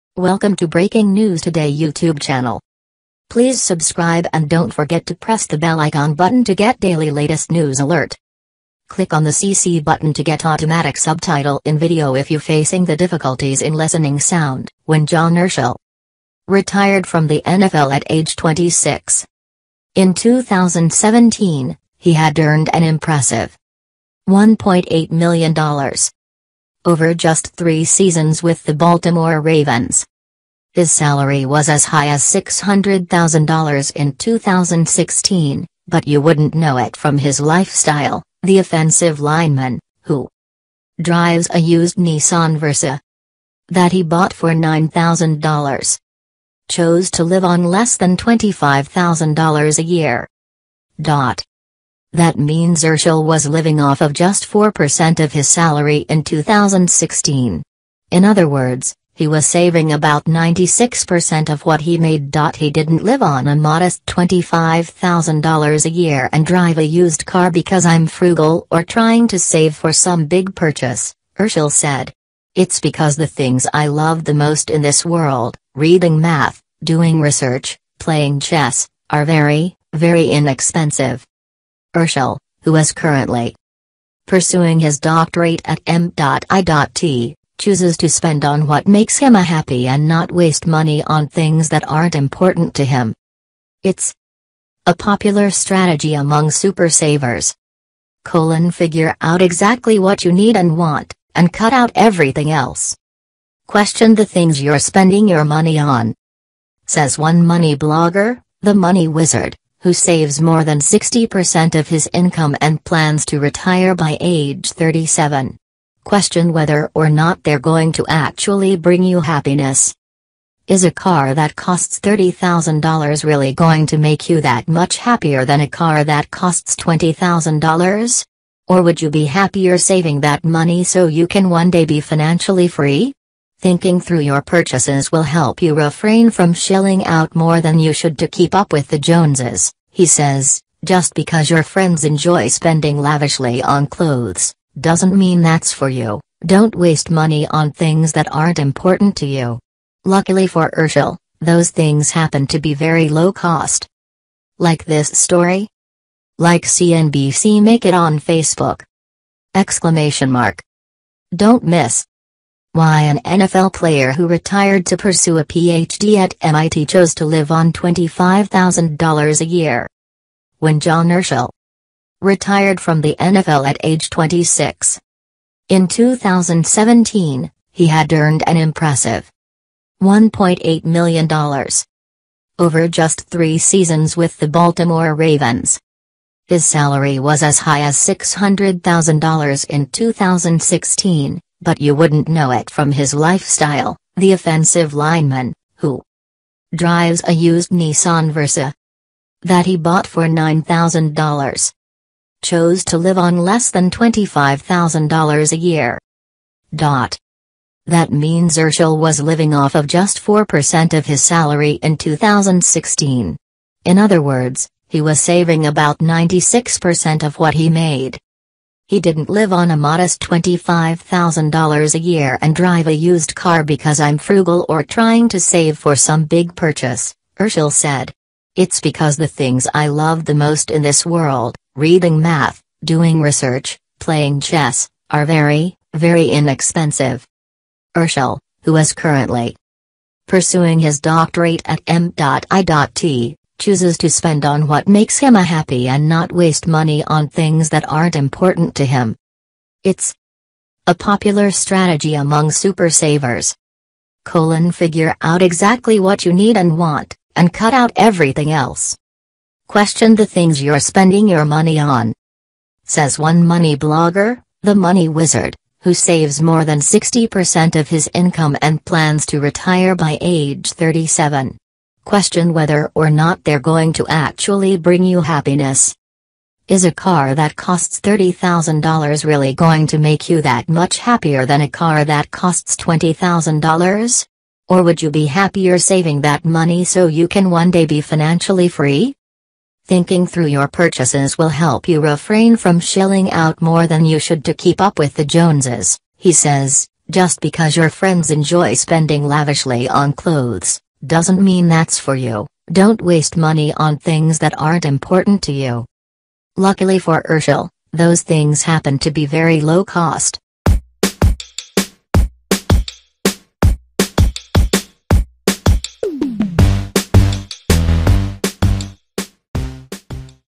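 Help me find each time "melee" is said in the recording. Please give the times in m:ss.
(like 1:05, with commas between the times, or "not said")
not said.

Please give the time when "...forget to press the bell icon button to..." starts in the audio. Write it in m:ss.
0:04.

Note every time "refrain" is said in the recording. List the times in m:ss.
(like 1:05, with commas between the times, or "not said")
2:15, 4:51.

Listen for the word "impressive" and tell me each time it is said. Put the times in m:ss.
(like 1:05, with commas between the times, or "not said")
0:22, 2:58.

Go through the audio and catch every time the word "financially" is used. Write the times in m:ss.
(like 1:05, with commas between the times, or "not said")
2:12, 4:48.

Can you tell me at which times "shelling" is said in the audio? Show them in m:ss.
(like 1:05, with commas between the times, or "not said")
2:16, 4:52.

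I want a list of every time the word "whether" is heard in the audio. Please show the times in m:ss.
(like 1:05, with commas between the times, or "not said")
1:56, 4:32.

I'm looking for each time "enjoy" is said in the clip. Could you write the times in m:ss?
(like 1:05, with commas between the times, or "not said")
2:22, 4:58.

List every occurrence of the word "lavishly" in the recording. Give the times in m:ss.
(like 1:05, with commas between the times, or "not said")
2:22, 4:59.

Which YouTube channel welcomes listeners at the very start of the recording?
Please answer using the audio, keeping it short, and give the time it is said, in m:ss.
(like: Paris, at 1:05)
Breaking News Today, at 0:00.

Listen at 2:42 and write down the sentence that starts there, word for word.
Why an NFL player who retired to pursue a PhD at MIT chose to live on $25,000 a year.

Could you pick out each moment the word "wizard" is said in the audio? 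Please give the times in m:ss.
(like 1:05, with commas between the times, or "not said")
1:49, 4:25.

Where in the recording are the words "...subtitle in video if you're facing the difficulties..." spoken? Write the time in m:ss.
0:10.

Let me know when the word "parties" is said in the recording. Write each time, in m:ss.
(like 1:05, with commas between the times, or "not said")
not said.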